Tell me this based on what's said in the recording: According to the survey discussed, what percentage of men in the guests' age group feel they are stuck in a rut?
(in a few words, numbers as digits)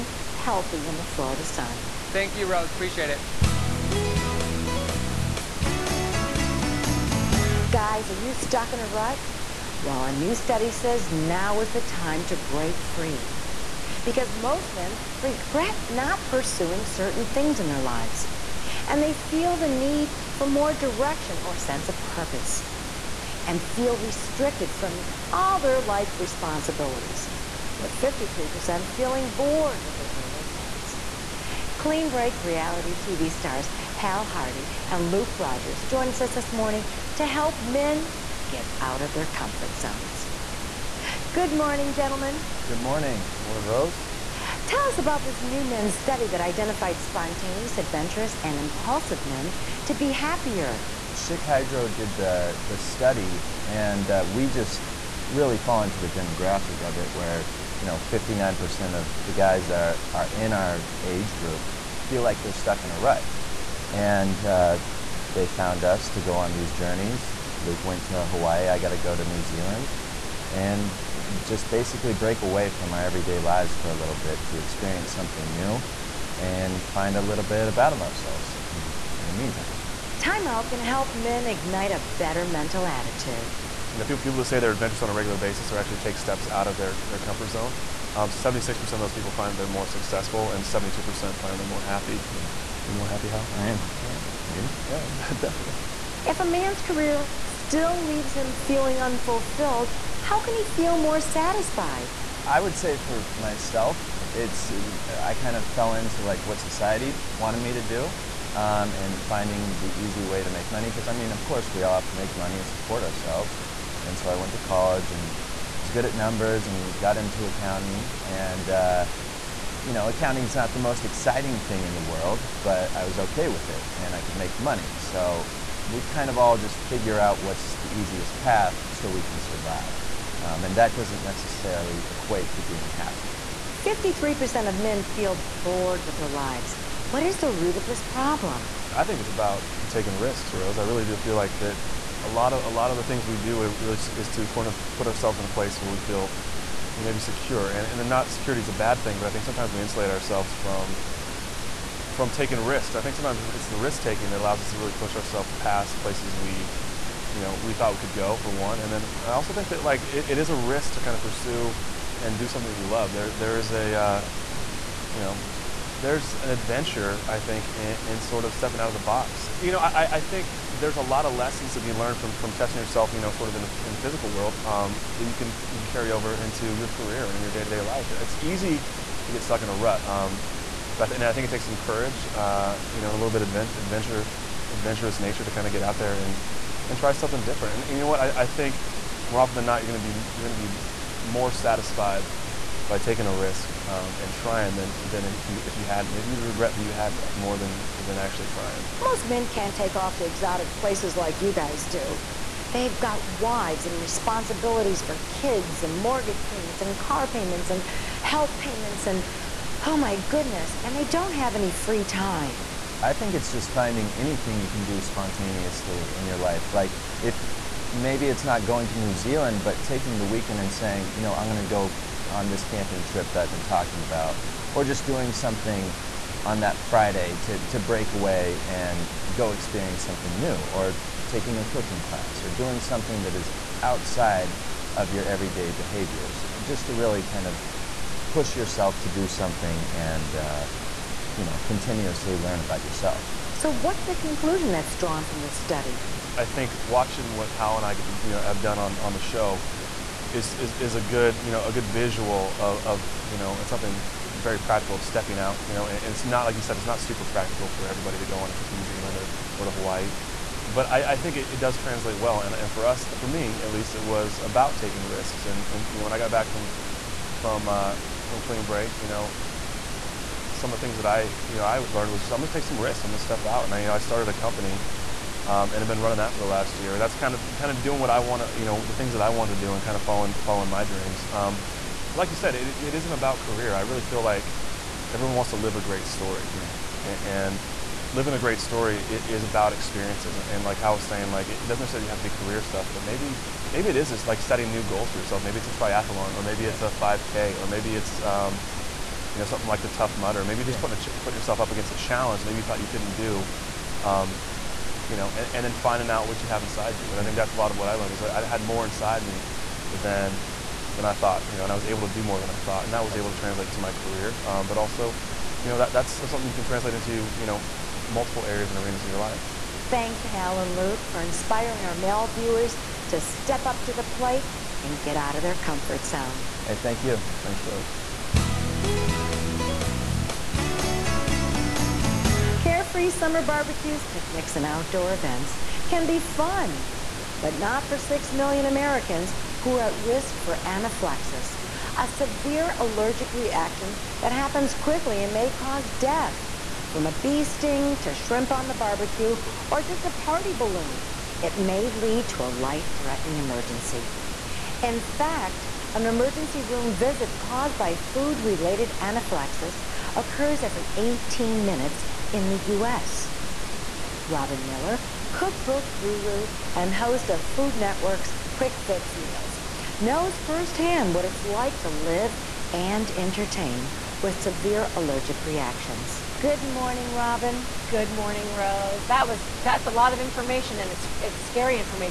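59%.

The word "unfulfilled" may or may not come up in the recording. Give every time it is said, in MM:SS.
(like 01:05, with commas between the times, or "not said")
01:39.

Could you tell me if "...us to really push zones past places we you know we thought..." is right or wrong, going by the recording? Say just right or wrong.
wrong.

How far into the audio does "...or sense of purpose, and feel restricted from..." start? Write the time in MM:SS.
00:21.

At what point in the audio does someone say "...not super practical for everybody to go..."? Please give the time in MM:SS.
04:16.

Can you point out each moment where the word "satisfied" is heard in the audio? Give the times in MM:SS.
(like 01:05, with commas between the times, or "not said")
01:41, 03:11.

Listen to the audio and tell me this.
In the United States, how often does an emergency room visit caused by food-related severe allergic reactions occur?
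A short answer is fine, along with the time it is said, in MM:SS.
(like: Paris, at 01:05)
Every 18 minutes, at 06:00.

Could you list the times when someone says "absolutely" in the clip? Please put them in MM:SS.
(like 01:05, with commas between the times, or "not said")
02:44, 05:13.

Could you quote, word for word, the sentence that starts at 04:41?
Um, but like you said, it, it isn't about career.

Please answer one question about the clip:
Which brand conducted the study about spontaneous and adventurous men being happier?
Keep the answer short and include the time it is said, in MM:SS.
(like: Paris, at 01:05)
Schick Hydro, at 00:51.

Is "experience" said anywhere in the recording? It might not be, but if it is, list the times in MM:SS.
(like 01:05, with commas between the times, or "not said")
01:14, 03:49, 04:49.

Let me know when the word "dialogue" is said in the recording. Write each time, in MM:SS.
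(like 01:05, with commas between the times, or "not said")
not said.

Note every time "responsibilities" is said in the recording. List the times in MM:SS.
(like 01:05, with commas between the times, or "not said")
00:26, 03:24.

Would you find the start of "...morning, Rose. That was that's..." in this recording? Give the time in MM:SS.
06:18.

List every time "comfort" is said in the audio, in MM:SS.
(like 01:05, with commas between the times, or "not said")
00:39, 01:27, 05:25.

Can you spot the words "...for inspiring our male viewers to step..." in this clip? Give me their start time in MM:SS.
05:21.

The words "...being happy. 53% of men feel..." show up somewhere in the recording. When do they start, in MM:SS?
02:12.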